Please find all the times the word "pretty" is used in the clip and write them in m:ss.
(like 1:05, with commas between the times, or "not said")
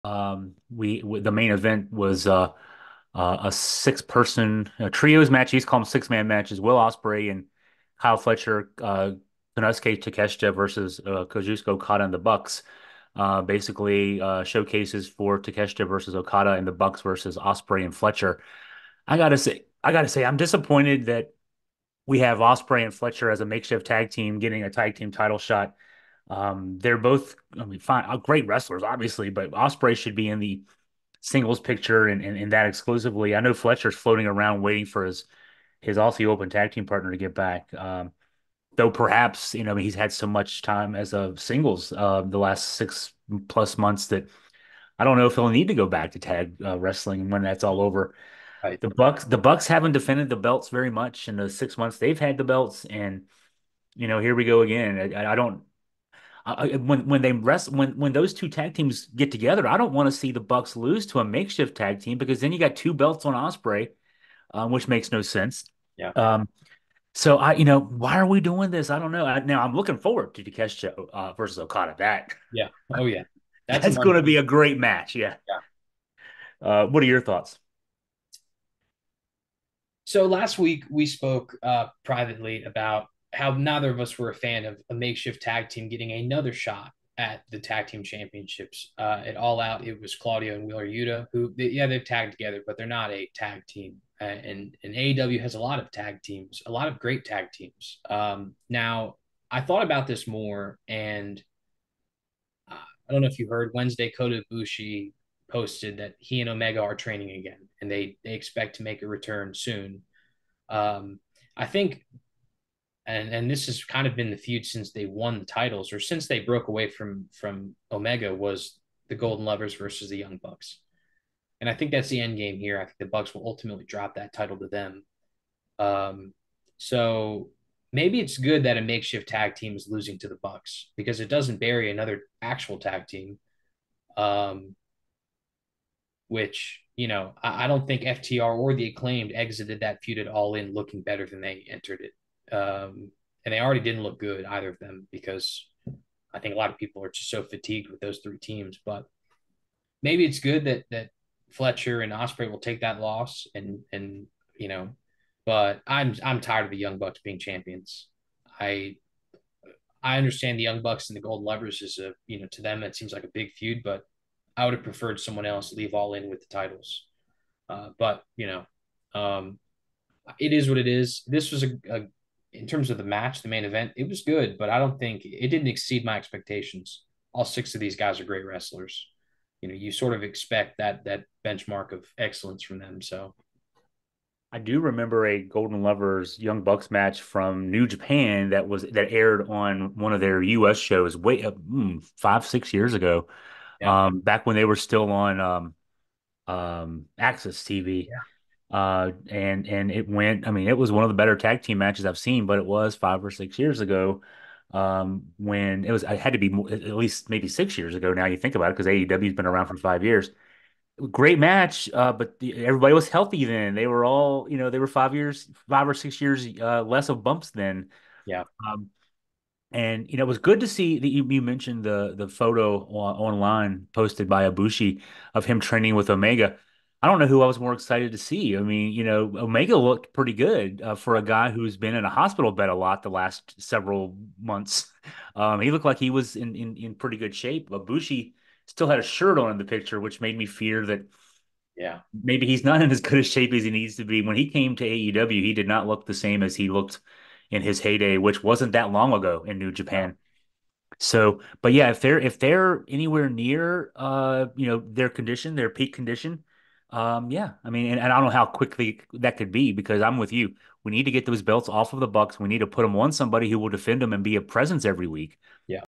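3:50, 3:56.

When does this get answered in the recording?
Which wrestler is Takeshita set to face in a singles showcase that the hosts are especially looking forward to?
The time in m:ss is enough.
0:11.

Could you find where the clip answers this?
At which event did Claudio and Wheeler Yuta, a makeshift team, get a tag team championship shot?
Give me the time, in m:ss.
1:29.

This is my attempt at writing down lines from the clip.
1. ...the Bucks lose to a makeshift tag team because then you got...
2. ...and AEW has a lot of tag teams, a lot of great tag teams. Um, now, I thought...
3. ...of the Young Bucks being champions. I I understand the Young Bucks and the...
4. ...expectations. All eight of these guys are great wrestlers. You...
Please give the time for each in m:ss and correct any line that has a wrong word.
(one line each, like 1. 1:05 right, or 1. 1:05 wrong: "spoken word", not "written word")
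1. 1:00 right
2. 1:34 right
3. 2:36 right
4. 2:56 wrong: "six", not "eight".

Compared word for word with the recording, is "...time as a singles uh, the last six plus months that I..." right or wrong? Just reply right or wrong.
right.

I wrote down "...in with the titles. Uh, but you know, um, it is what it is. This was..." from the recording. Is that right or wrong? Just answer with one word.
right.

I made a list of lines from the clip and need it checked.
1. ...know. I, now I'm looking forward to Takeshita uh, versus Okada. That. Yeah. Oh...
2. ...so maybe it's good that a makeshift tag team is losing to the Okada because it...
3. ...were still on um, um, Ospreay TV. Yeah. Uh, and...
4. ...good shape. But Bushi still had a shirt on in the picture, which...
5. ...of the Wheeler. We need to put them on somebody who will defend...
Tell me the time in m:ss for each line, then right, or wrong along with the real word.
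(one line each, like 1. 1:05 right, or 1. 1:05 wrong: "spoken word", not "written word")
1. 1:09 right
2. 2:06 wrong: "Bucks", not "Okada"
3. 3:14 wrong: "AXS", not "Ospreay"
4. 3:57 right
5. 4:21 wrong: "Bucks", not "Wheeler".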